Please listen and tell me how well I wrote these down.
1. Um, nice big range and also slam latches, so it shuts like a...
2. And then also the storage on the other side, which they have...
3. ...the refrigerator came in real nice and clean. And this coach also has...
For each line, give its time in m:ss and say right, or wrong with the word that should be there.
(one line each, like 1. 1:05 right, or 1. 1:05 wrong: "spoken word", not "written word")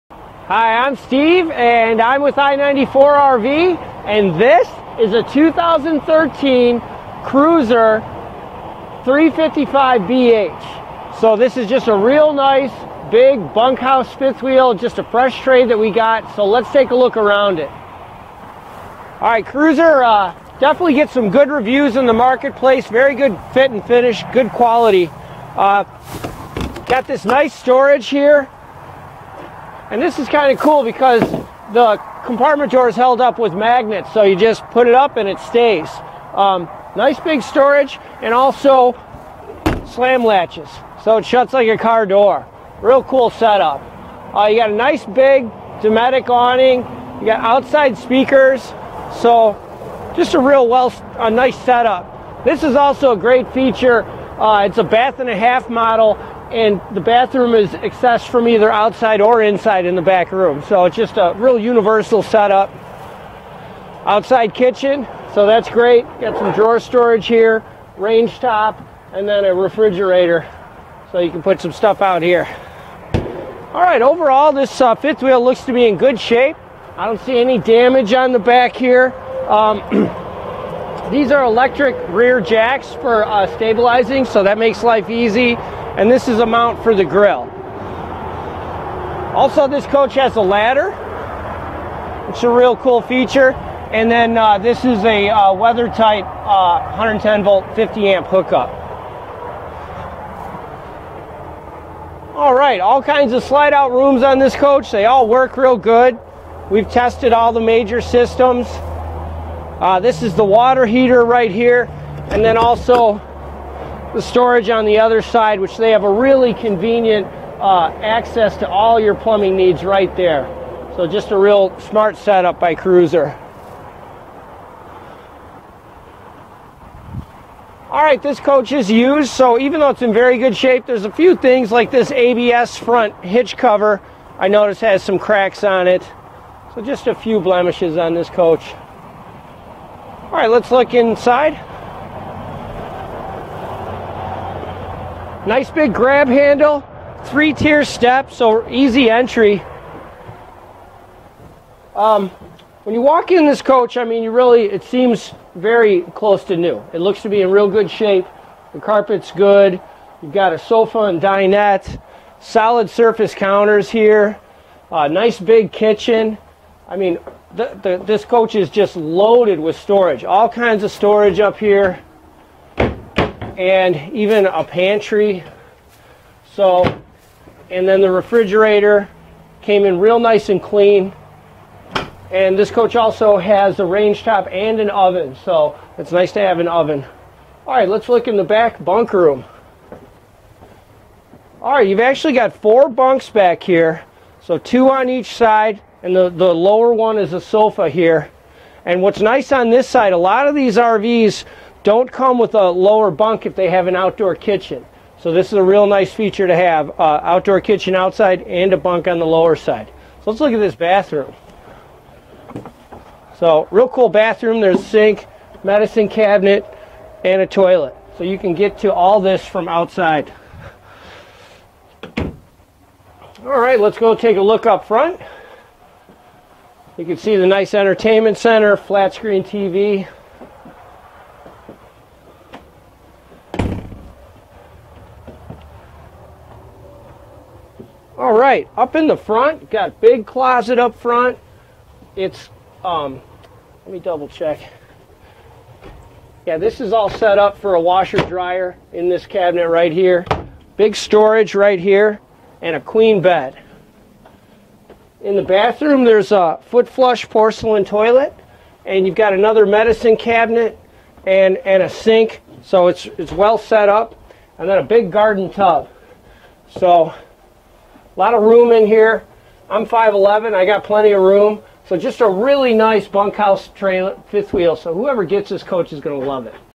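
1. 0:36 wrong: "storage", not "range"
2. 1:52 right
3. 2:58 right.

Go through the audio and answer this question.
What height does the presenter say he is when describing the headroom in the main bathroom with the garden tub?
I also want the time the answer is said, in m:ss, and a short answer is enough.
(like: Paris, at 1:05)
5'11", at 4:29.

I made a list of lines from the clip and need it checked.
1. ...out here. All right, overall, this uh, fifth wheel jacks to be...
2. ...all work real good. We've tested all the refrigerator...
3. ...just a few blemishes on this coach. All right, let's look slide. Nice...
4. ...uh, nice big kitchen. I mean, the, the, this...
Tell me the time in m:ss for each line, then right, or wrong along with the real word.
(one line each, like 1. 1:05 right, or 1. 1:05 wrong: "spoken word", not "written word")
1. 1:12 wrong: "looks", not "jacks"
2. 1:45 wrong: "major", not "refrigerator"
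3. 2:16 wrong: "inside", not "slide"
4. 2:44 right.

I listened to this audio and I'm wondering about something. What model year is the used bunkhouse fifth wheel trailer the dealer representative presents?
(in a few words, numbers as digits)
2013.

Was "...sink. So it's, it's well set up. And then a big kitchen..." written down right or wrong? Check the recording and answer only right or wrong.
wrong.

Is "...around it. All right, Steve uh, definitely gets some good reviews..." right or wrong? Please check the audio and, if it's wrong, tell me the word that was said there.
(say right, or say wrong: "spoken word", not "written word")
wrong: "Crusader", not "Steve".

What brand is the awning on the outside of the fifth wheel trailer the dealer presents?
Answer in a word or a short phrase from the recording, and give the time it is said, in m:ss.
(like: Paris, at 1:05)
Dometic, at 0:45.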